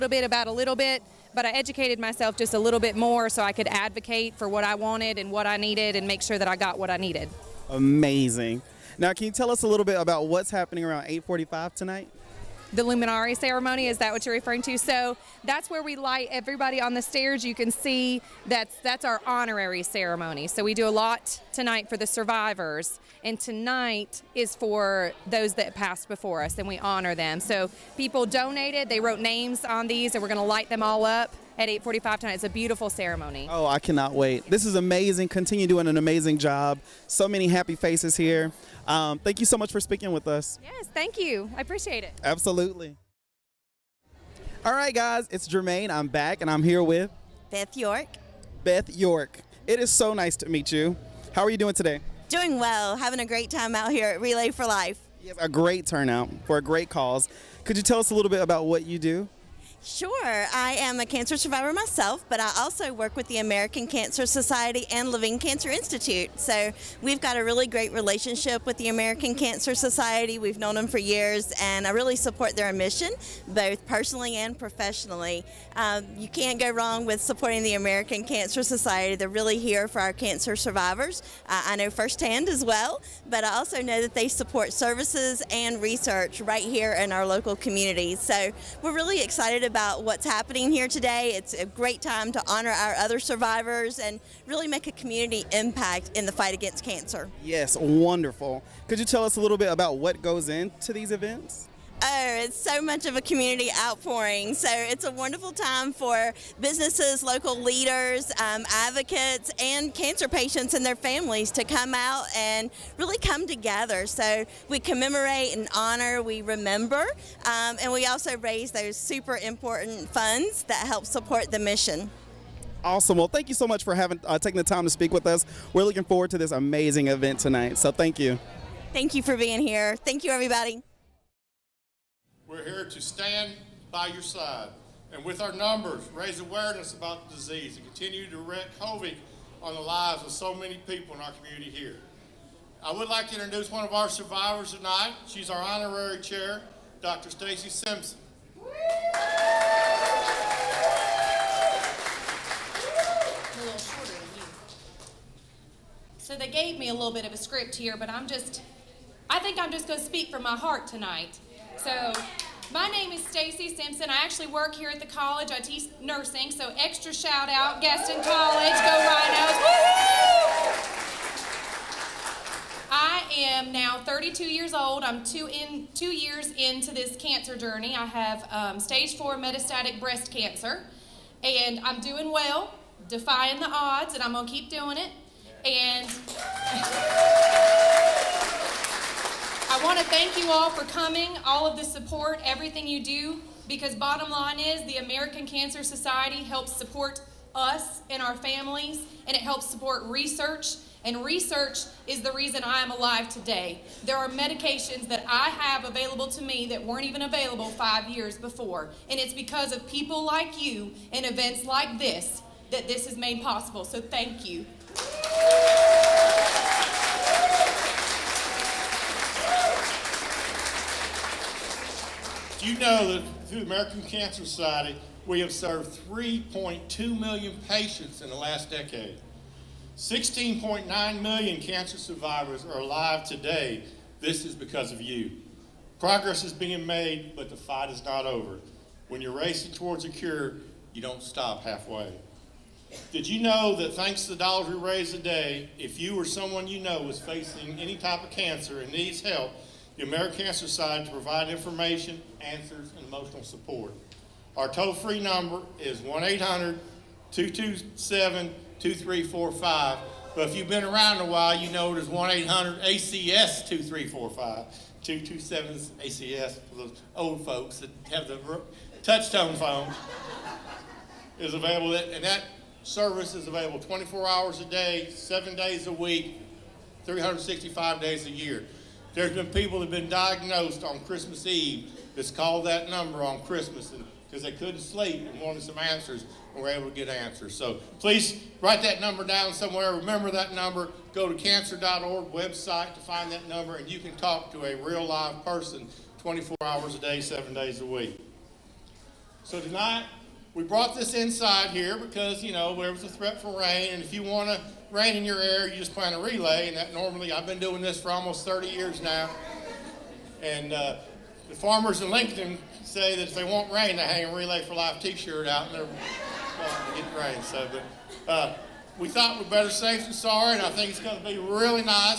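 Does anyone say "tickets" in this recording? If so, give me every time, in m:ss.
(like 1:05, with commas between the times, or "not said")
not said.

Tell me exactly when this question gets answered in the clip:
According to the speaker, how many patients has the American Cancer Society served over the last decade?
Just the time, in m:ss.
3:46.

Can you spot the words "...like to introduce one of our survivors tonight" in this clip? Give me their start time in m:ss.
2:23.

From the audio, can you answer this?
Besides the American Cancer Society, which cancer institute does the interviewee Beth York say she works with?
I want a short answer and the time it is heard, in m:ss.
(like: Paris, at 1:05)
Levine Cancer Institute, at 1:05.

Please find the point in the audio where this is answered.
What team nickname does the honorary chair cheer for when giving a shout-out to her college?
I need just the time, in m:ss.
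2:48.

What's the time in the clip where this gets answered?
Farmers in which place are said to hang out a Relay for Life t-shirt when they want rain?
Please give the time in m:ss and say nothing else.
5:12.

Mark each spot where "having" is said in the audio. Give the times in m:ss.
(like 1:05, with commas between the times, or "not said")
0:52, 2:03.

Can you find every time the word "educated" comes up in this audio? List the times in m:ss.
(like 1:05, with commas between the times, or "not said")
0:01.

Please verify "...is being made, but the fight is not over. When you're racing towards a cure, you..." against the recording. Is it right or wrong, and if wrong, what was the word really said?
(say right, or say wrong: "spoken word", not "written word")
right.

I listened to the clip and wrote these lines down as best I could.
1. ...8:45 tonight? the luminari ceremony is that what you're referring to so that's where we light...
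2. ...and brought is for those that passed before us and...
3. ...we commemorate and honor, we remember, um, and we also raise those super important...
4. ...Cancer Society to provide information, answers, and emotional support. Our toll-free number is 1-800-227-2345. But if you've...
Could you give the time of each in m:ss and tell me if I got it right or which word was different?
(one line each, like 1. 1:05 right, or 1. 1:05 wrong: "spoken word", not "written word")
1. 0:11 right
2. 0:23 wrong: "tonight", not "brought"
3. 1:54 right
4. 4:10 right.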